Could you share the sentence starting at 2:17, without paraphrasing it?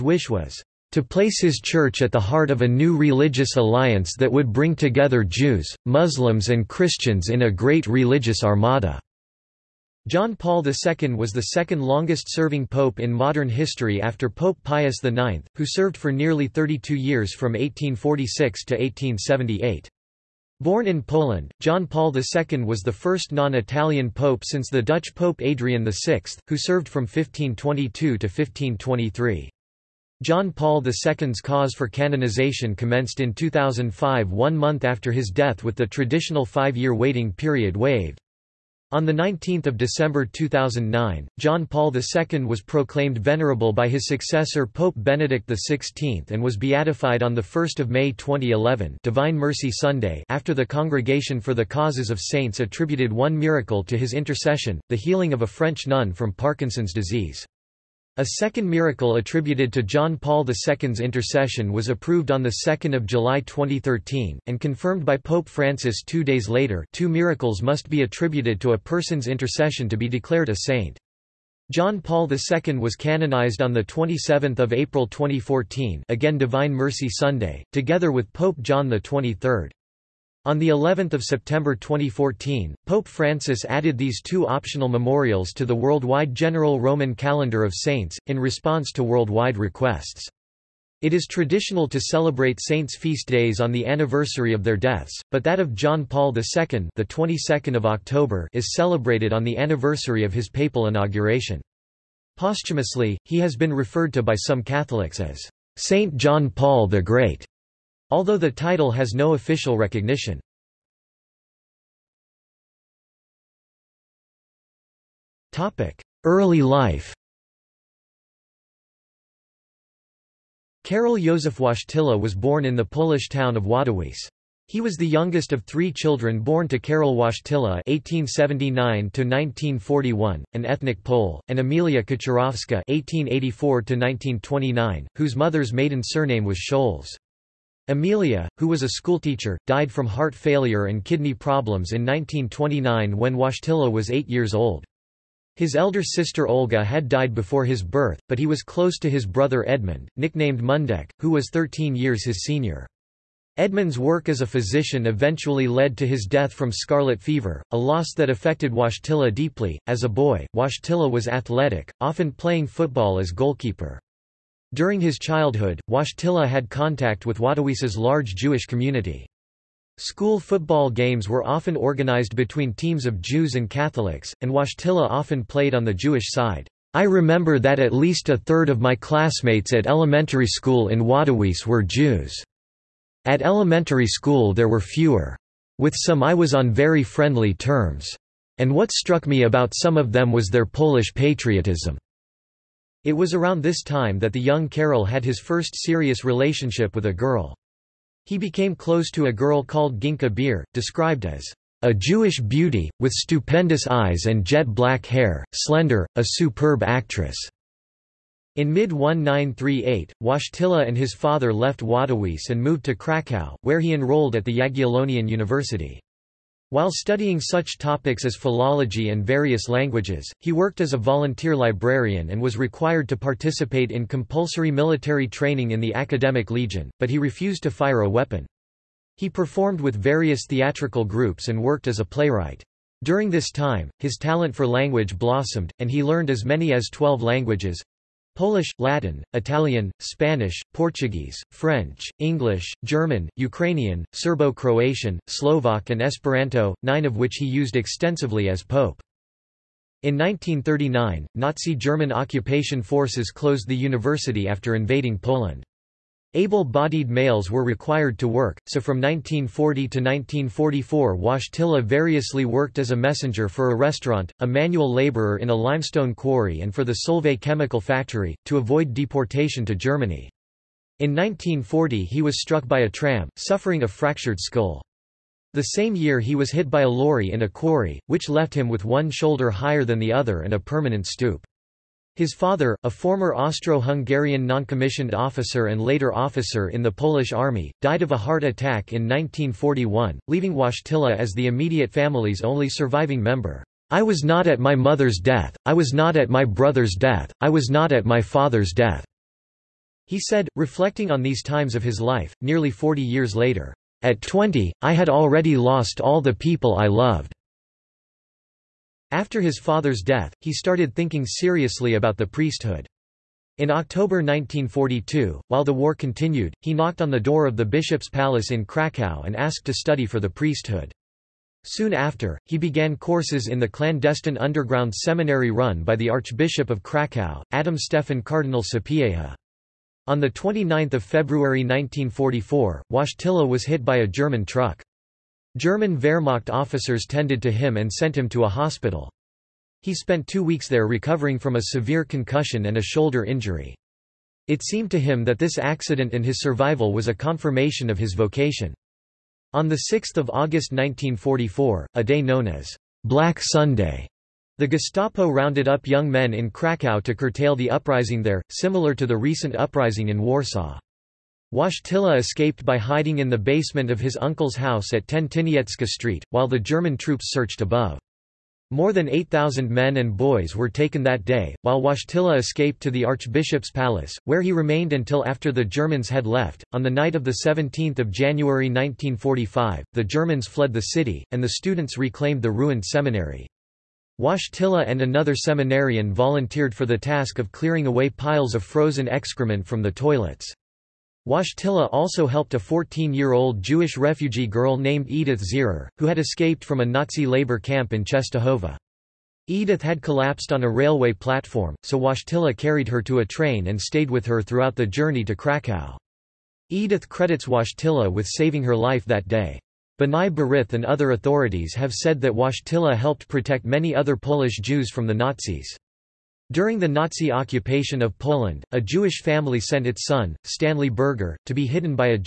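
Emilia, who was a schoolteacher, died from heart failure and kidney problems in 1929 when Wojtyla was eight years old.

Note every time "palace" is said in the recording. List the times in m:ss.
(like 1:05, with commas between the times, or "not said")
5:18, 6:13.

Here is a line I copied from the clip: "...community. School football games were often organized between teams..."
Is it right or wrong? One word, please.
right.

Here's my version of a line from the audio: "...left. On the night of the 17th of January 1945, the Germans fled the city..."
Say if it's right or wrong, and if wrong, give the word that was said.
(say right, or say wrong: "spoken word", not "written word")
right.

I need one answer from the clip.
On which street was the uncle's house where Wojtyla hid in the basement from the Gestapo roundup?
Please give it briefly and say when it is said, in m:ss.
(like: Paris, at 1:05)
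Tentinietska Street, at 6:05.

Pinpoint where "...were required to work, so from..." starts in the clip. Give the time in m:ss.
4:17.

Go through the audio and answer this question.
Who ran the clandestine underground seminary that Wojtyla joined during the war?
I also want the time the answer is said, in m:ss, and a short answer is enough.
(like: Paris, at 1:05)
Adam Stefan Cardinal Sapieha, at 5:27.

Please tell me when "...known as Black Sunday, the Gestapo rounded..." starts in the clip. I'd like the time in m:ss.
5:52.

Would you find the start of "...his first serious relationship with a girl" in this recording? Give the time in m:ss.
3:15.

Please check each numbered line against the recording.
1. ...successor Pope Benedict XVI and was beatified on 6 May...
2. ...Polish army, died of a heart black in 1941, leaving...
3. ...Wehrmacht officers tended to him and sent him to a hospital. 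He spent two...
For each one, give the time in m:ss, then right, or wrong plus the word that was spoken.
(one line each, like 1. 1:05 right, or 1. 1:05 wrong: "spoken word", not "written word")
1. 0:44 wrong: "1", not "6"
2. 4:46 wrong: "attack", not "black"
3. 5:35 right.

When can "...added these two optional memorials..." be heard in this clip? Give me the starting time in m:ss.
1:23.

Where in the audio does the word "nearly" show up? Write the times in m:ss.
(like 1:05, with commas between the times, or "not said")
0:16, 5:02.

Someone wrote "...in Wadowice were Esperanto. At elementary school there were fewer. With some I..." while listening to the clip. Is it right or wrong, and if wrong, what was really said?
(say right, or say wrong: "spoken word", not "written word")
wrong: "Jews", not "Esperanto".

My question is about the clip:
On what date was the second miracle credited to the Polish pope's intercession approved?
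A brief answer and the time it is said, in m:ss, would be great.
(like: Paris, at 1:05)
2 July 2013, at 1:02.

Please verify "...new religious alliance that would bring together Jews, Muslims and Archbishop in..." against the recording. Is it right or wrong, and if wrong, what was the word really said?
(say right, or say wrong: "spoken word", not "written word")
wrong: "Christians", not "Archbishop".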